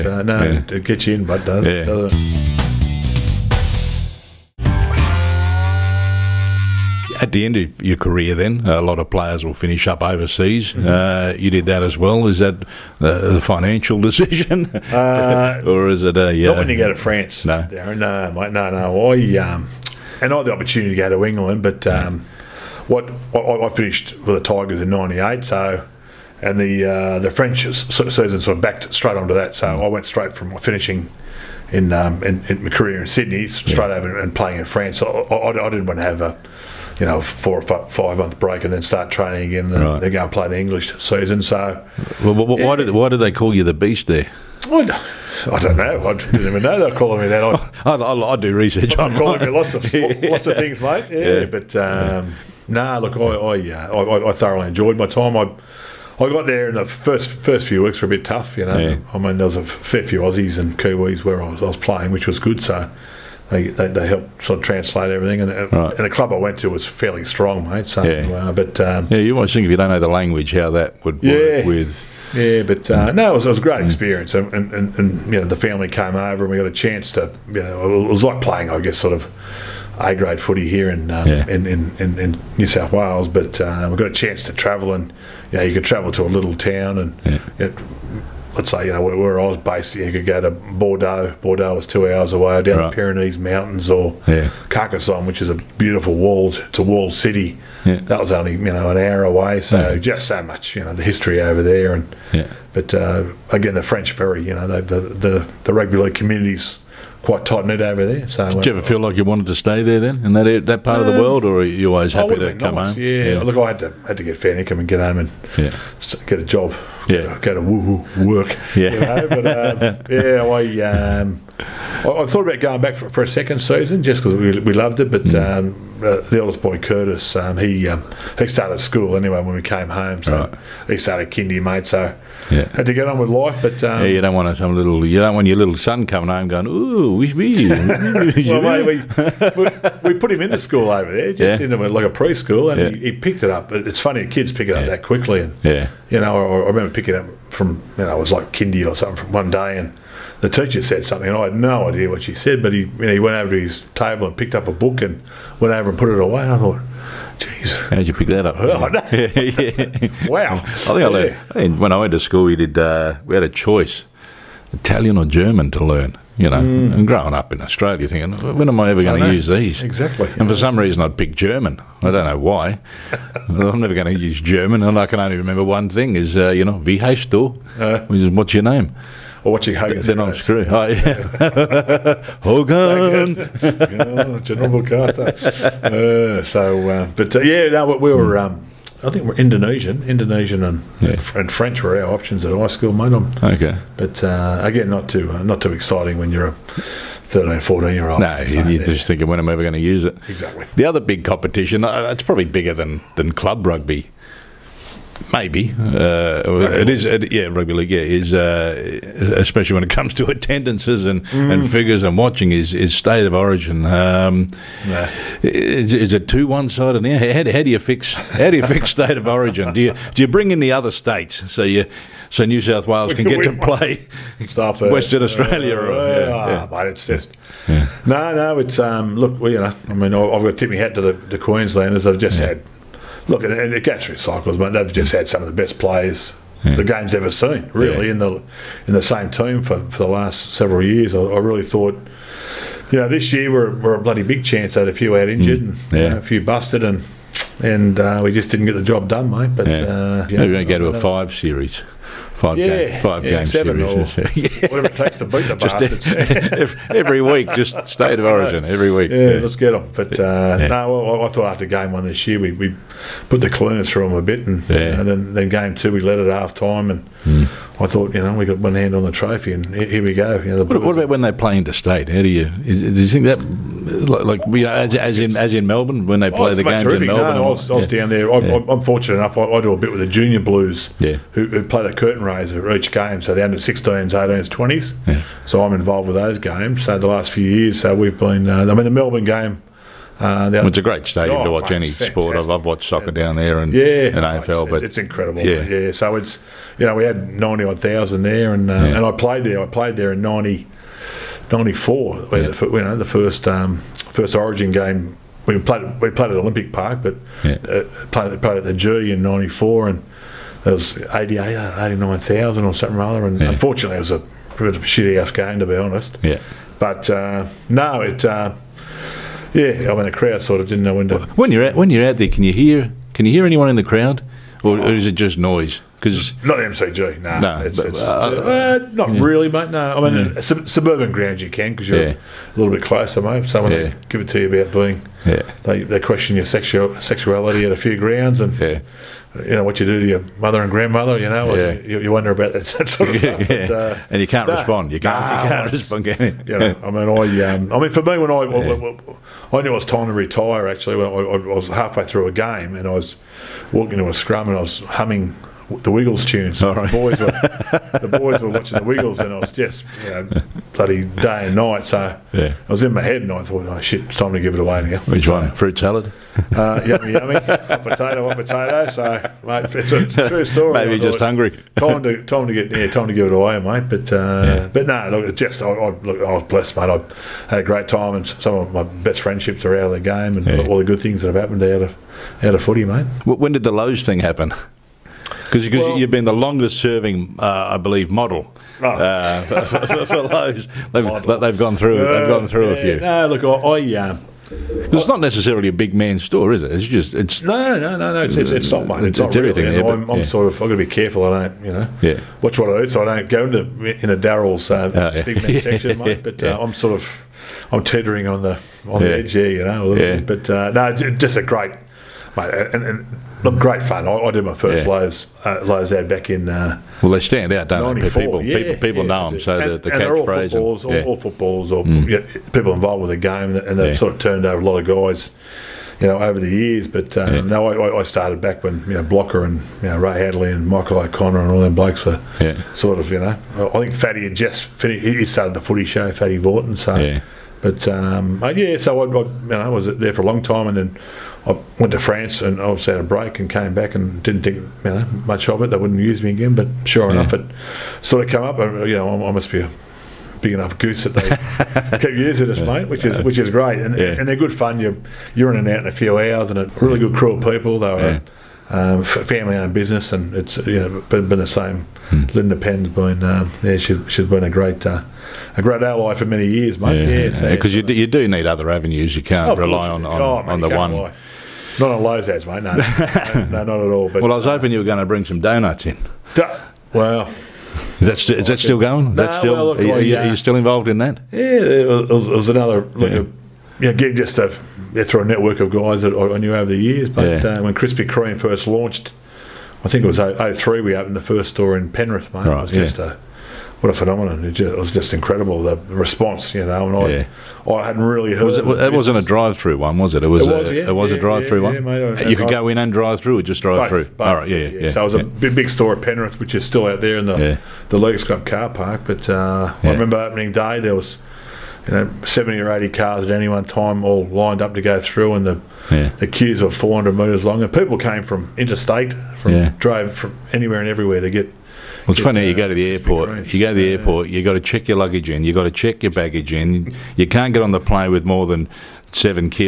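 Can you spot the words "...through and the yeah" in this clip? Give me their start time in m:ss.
8:35.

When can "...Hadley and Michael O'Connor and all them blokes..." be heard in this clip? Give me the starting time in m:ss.
7:10.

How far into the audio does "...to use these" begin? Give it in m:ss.
2:49.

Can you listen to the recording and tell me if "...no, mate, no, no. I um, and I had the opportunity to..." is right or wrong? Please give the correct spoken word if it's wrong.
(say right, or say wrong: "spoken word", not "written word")
right.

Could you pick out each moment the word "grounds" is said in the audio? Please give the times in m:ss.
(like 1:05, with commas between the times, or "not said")
5:31, 5:37.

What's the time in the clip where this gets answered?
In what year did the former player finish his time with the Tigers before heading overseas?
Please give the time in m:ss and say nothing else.
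0:24.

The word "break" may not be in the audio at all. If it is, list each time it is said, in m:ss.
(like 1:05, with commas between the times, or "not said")
0:38, 7:23.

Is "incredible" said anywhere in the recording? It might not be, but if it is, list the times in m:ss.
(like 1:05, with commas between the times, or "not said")
4:54, 8:15.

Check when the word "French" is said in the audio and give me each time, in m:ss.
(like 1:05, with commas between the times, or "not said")
0:27, 1:43, 3:11.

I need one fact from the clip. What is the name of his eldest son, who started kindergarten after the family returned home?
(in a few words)
Curtis.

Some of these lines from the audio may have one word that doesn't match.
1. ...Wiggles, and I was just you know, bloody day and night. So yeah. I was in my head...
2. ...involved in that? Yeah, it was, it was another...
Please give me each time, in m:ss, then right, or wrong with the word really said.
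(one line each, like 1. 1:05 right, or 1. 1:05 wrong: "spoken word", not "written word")
1. 5:58 right
2. 8:00 right.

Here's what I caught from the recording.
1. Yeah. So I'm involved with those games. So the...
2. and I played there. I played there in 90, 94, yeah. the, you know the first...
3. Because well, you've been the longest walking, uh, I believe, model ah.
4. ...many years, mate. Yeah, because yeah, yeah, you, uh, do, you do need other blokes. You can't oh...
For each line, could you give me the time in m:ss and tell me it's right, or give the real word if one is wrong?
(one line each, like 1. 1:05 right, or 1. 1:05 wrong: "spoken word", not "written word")
1. 4:45 right
2. 4:58 right
3. 6:25 wrong: "serving", not "walking"
4. 7:46 wrong: "avenues", not "blokes".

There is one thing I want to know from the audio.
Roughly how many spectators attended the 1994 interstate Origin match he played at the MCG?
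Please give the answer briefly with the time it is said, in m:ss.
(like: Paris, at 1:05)
89,000, at 5:11.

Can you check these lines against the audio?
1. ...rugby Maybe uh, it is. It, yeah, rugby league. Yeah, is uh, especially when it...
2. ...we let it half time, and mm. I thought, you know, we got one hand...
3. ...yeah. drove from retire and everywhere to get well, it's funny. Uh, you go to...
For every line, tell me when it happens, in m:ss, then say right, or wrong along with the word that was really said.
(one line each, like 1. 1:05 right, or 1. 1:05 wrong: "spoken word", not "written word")
1. 3:23 right
2. 4:25 right
3. 8:39 wrong: "anywhere", not "retire".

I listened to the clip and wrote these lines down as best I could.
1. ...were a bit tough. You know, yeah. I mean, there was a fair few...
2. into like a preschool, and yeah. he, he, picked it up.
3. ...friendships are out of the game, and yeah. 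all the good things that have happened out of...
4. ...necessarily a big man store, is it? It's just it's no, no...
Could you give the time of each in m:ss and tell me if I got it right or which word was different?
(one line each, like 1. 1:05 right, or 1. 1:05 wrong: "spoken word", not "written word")
1. 0:58 right
2. 2:21 right
3. 6:19 right
4. 6:35 right.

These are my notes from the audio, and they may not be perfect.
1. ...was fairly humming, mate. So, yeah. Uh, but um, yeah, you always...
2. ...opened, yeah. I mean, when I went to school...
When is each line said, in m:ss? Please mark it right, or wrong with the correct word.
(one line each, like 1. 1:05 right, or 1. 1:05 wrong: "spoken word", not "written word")
1. 1:06 wrong: "strong", not "humming"
2. 2:41 wrong: "learned", not "opened".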